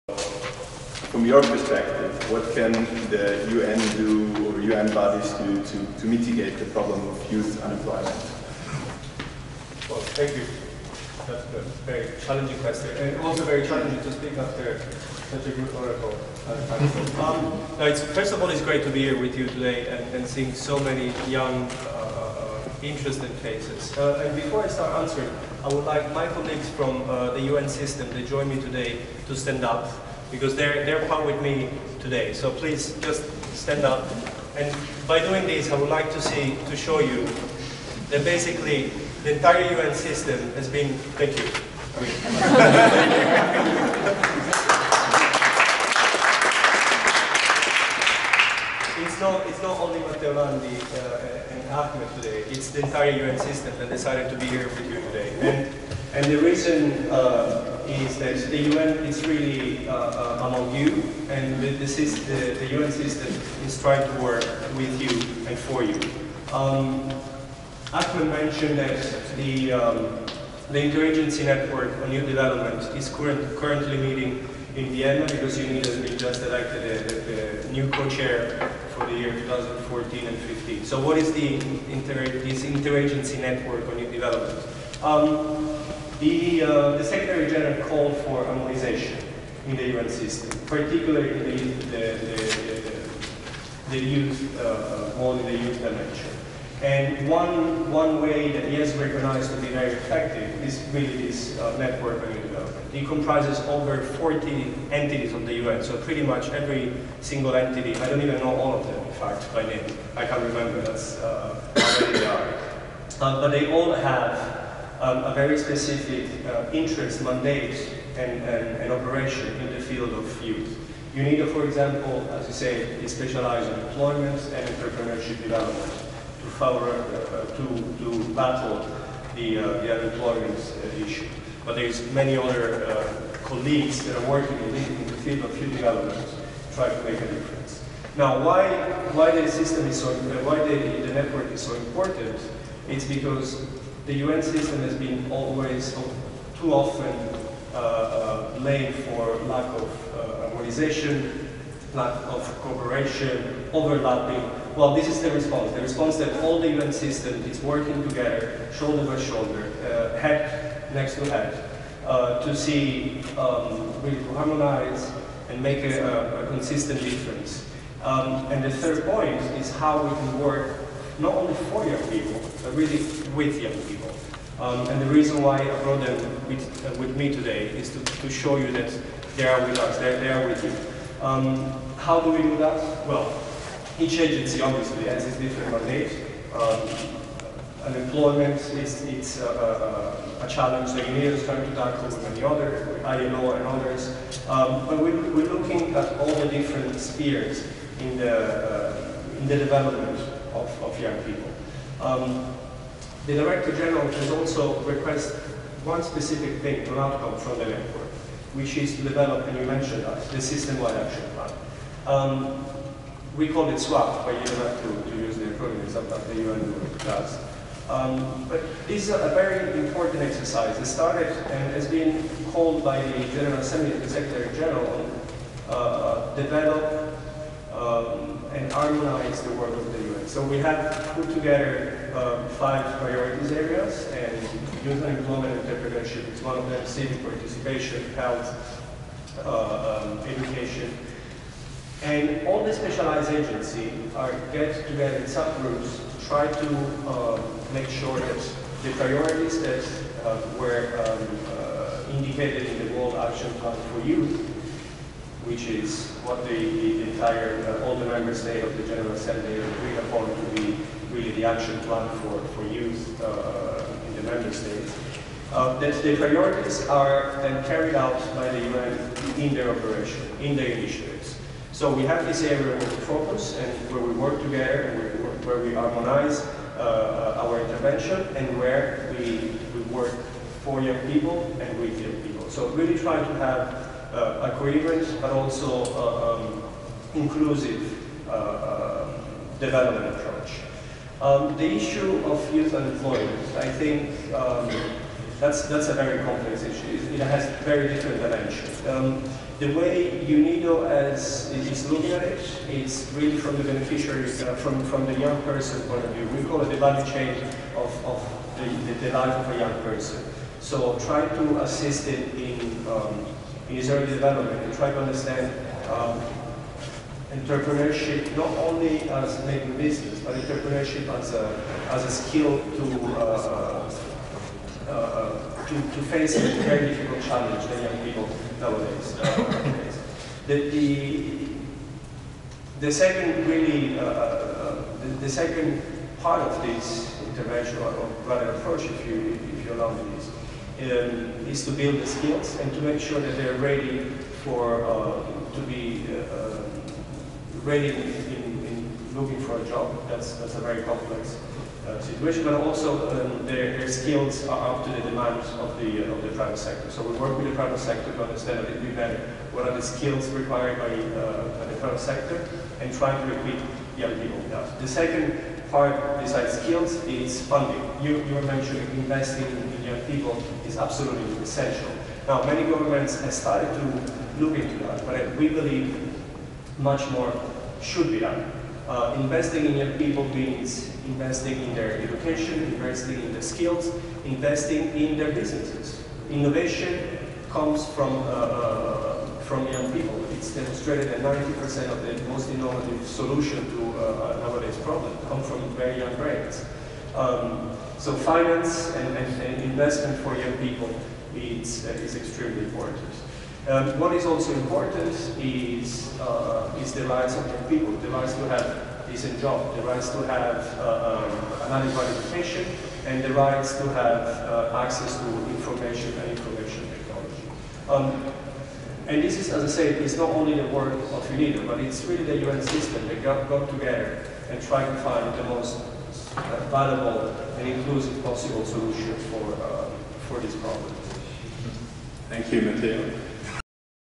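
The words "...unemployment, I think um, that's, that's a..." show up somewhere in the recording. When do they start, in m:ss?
4:52.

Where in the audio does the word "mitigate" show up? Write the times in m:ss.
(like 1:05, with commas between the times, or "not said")
0:06.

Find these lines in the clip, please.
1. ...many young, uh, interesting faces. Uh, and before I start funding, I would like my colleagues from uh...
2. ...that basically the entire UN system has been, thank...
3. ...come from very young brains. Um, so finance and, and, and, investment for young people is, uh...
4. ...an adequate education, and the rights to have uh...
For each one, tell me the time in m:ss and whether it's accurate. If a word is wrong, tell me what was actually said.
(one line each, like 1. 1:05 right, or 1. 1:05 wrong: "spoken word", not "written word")
1. 0:20 wrong: "answering", not "funding"
2. 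0:38 right
3. 6:35 right
4. 6:51 right.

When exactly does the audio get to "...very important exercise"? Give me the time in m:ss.
3:39.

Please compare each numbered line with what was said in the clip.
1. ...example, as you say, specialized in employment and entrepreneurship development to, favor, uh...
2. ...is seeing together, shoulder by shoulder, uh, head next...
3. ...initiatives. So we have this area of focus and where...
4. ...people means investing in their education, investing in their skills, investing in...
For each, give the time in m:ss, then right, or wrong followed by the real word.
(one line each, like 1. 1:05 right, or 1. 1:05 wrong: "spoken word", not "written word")
1. 2:01 right
2. 2:37 wrong: "working", not "seeing"
3. 4:30 right
4. 6:19 right.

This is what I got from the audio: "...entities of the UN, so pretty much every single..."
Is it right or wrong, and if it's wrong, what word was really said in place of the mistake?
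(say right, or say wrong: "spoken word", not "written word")
right.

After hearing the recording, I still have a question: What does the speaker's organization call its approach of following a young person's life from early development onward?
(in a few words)
value chain.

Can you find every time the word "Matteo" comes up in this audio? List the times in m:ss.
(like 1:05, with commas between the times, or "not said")
0:49, 7:12.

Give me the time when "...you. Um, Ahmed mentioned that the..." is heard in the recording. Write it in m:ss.
1:05.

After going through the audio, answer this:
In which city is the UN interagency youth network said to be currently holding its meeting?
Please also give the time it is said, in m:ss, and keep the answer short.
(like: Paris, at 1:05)
Vienna, at 1:14.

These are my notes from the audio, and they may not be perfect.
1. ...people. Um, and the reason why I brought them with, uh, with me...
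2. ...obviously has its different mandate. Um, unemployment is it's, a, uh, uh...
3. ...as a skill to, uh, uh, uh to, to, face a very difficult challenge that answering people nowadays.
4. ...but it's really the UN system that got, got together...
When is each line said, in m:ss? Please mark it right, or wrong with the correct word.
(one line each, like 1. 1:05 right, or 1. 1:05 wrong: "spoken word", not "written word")
1. 2:53 right
2. 3:04 right
3. 5:21 wrong: "young", not "answering"
4. 7:01 right.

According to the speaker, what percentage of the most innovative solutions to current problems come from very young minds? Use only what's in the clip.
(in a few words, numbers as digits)
90%.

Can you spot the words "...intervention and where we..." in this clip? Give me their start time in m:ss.
4:37.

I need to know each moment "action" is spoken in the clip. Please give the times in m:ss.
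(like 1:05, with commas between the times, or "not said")
3:30, 4:13, 4:21.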